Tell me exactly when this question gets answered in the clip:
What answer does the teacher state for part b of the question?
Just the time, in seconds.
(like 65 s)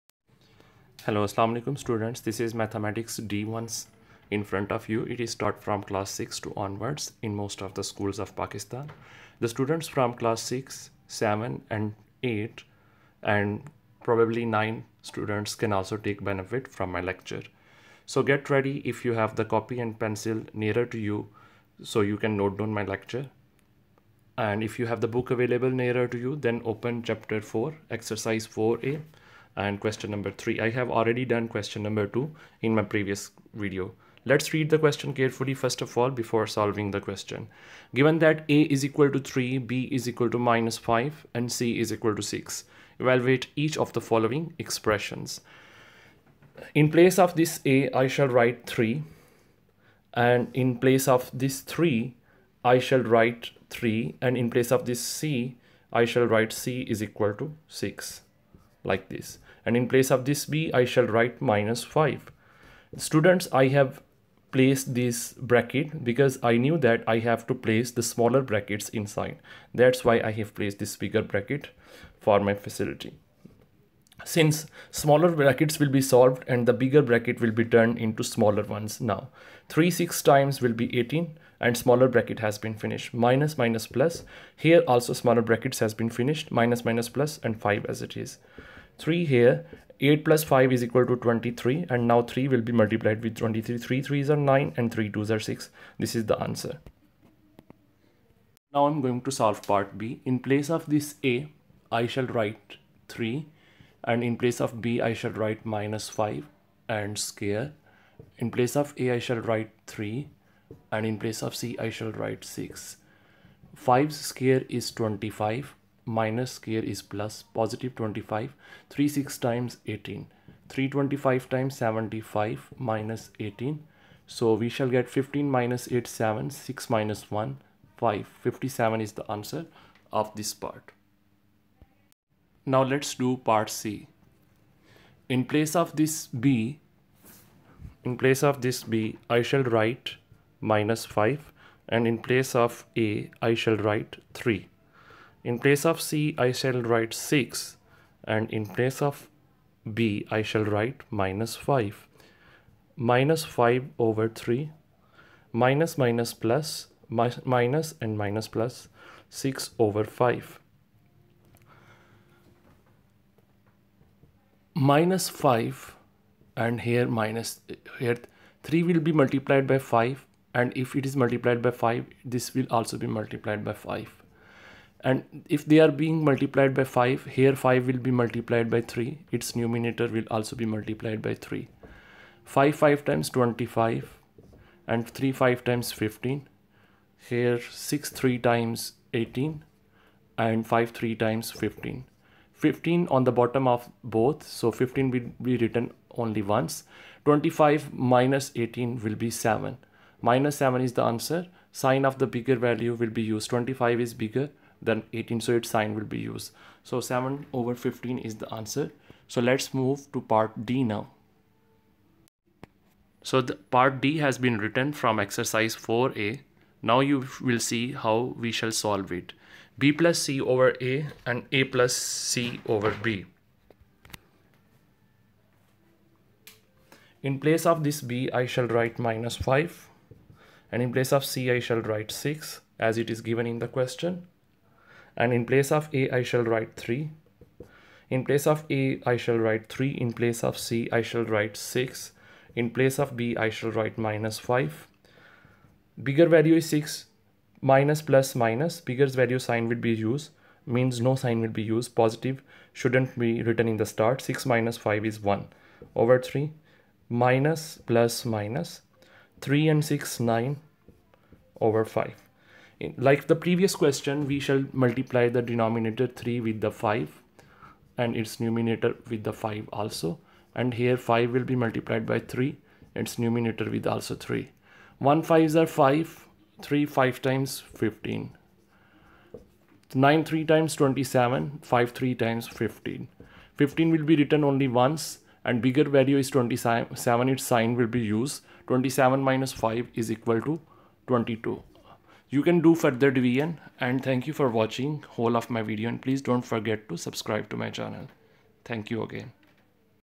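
128 s.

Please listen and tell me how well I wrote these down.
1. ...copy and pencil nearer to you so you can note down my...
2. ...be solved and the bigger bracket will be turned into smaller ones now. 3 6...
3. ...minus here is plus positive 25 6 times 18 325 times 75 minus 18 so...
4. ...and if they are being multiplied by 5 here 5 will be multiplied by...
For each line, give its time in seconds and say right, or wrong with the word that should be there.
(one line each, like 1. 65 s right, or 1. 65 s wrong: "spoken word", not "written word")
1. 19 s right
2. 75 s right
3. 116 s right
4. 175 s right.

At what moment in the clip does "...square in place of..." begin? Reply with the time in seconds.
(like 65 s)
107 s.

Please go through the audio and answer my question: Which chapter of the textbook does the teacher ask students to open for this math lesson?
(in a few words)
Chapter 4.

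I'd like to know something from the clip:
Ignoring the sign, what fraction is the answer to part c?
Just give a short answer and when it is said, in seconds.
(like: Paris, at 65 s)
7/15, at 206 s.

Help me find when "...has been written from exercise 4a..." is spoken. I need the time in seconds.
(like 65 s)
214 s.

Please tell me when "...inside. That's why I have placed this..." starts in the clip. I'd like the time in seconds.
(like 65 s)
68 s.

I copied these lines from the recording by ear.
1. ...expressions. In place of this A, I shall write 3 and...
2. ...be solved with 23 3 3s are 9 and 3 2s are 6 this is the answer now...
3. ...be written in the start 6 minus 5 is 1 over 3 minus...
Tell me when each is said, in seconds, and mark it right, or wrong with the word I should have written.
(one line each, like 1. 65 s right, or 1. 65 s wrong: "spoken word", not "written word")
1. 44 s right
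2. 92 s wrong: "multiplied", not "solved"
3. 253 s right.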